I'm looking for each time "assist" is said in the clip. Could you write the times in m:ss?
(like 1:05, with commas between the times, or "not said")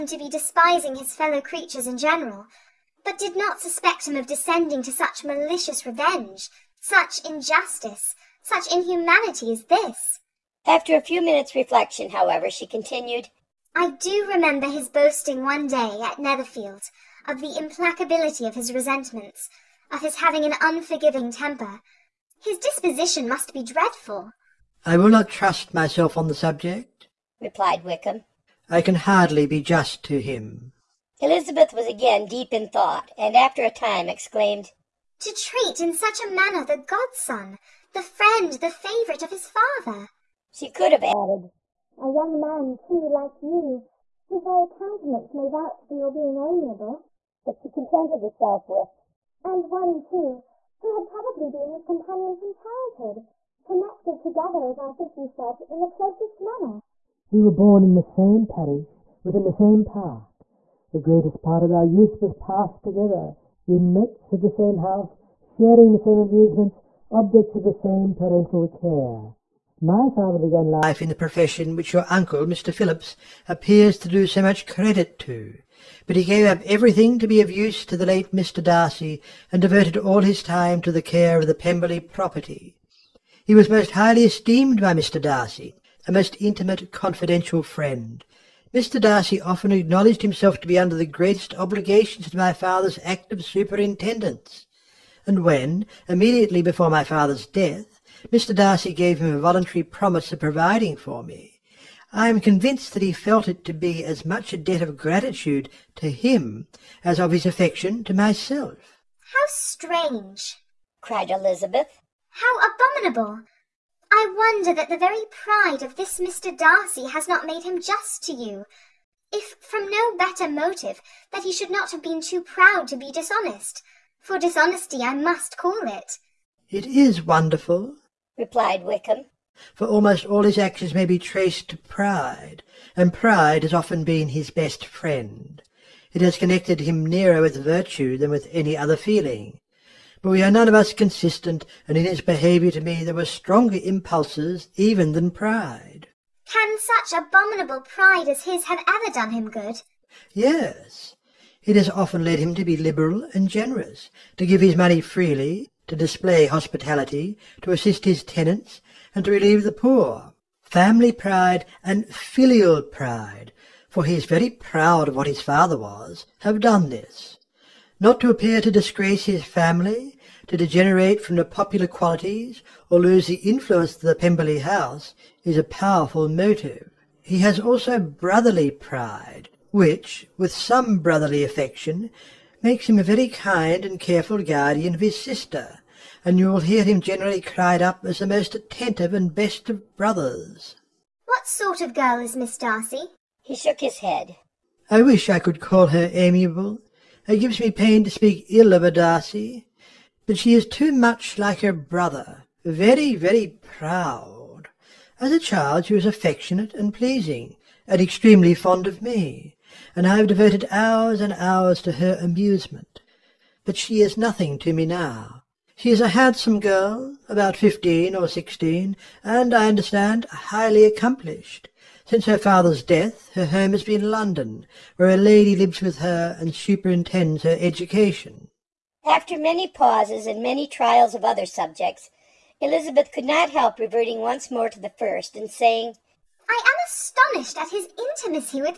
2:37.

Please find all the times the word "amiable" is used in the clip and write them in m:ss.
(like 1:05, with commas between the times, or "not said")
0:46, 3:16.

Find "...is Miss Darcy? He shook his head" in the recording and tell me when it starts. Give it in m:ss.
3:12.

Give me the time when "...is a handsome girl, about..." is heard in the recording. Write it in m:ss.
3:35.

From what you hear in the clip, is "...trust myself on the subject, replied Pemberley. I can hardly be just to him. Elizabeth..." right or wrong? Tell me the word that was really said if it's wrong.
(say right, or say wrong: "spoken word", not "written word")
wrong: "Wickham", not "Pemberley".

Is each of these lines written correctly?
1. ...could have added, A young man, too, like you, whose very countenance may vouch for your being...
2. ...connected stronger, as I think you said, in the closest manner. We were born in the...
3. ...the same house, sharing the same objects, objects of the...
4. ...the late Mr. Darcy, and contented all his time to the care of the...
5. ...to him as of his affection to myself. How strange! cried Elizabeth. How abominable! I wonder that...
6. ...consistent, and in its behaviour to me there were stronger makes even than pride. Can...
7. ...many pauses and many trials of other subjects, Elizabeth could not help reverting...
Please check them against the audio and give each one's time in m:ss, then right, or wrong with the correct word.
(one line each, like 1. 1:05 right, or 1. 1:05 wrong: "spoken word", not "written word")
1. 0:40 right
2. 0:53 wrong: "together", not "stronger"
3. 1:04 wrong: "amusements", not "objects"
4. 1:17 wrong: "devoted", not "contented"
5. 1:45 right
6. 2:20 wrong: "impulses", not "makes"
7. 3:49 right.